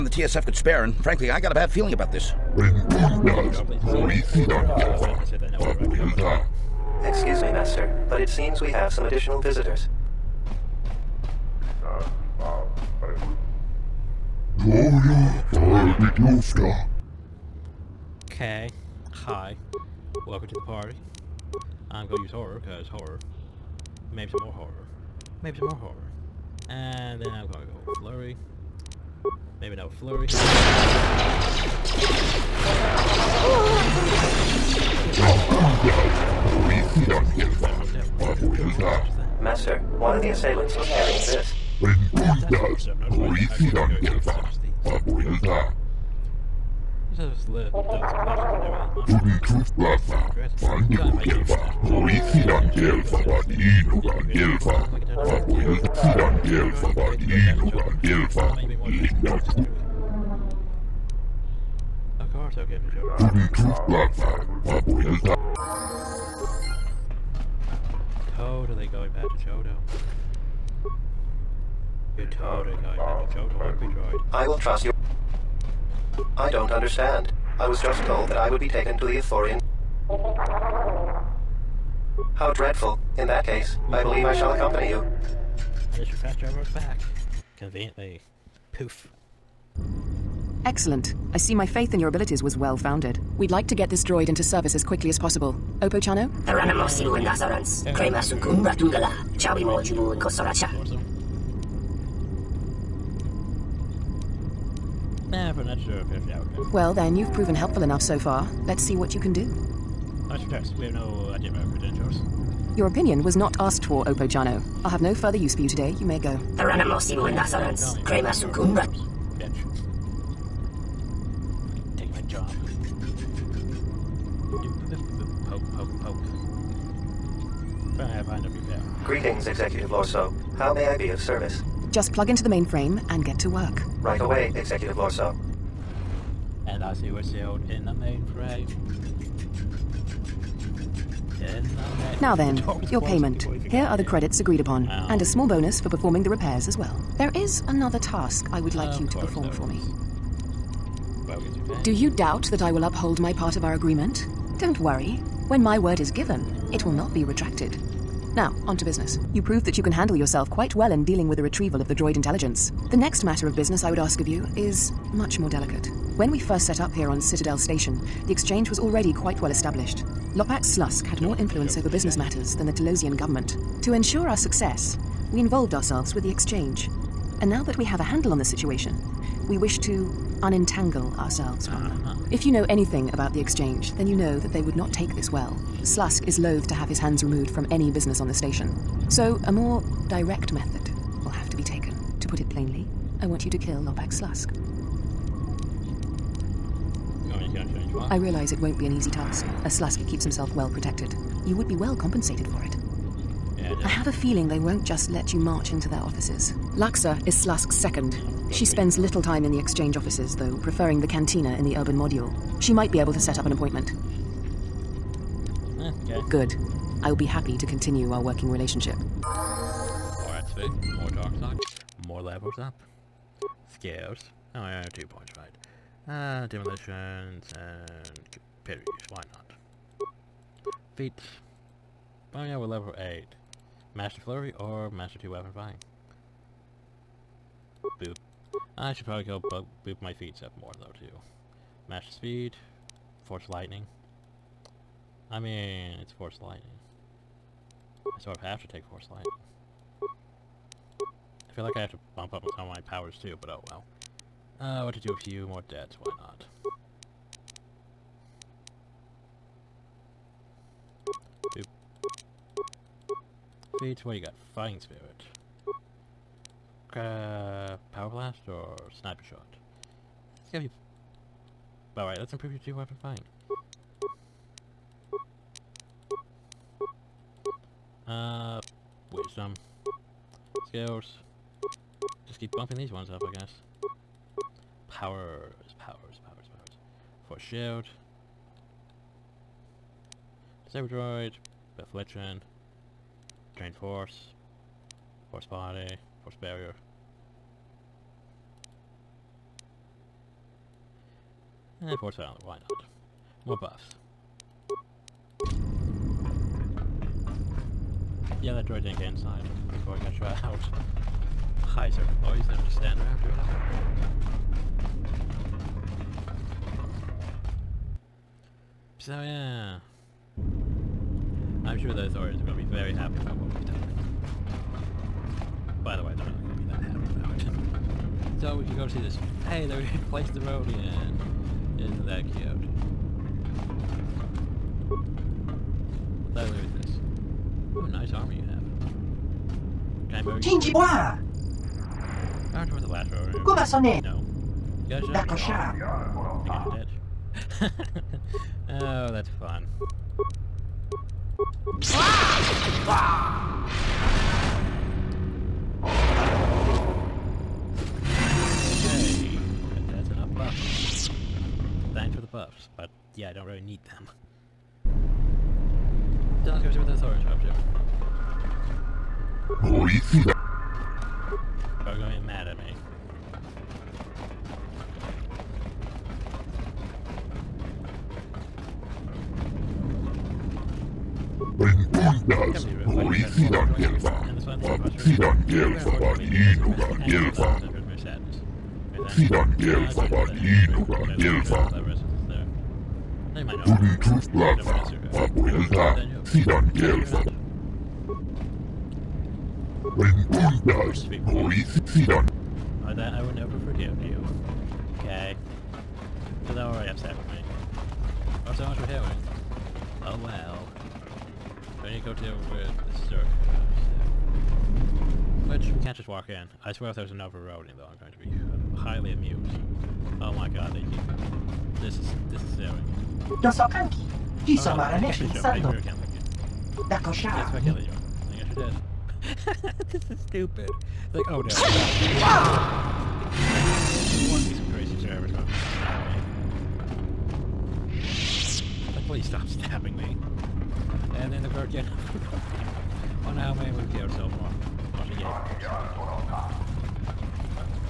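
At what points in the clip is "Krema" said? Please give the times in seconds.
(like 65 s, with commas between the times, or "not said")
97 s, 118 s.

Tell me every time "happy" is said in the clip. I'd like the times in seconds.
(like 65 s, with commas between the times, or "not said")
217 s, 322 s, 327 s.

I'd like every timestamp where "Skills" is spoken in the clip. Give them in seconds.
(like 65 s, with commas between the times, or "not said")
223 s, 280 s.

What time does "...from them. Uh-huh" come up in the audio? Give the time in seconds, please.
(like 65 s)
181 s.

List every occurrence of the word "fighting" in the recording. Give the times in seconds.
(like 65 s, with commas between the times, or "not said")
264 s, 273 s.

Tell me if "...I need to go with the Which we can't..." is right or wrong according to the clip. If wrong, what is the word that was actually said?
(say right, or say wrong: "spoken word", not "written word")
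right.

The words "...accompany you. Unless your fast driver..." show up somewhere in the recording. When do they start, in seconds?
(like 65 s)
84 s.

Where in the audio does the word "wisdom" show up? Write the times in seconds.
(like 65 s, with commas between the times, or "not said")
279 s.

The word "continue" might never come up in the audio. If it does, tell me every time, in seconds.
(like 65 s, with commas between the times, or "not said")
217 s.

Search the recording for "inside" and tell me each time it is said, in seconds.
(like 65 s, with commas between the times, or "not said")
309 s.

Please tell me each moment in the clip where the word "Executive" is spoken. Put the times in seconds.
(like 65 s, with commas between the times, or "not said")
129 s, 134 s.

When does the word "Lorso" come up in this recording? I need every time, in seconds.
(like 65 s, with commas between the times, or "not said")
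129 s, 134 s.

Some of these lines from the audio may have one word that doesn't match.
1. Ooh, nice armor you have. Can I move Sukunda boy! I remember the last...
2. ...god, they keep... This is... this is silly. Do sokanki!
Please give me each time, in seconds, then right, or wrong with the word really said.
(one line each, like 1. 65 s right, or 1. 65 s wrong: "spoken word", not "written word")
1. 337 s wrong: "Shinji", not "Sukunda"
2. 420 s right.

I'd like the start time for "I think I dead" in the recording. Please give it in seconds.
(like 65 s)
346 s.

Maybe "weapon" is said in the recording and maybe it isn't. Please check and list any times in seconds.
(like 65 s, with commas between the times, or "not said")
235 s, 272 s.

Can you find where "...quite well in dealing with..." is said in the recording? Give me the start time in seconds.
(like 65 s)
160 s.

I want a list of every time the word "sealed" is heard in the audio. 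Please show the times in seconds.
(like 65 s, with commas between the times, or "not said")
137 s.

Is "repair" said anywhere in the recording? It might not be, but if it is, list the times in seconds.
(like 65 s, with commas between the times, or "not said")
128 s, 146 s.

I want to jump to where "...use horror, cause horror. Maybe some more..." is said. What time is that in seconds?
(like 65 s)
22 s.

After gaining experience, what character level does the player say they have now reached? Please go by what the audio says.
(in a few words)
8.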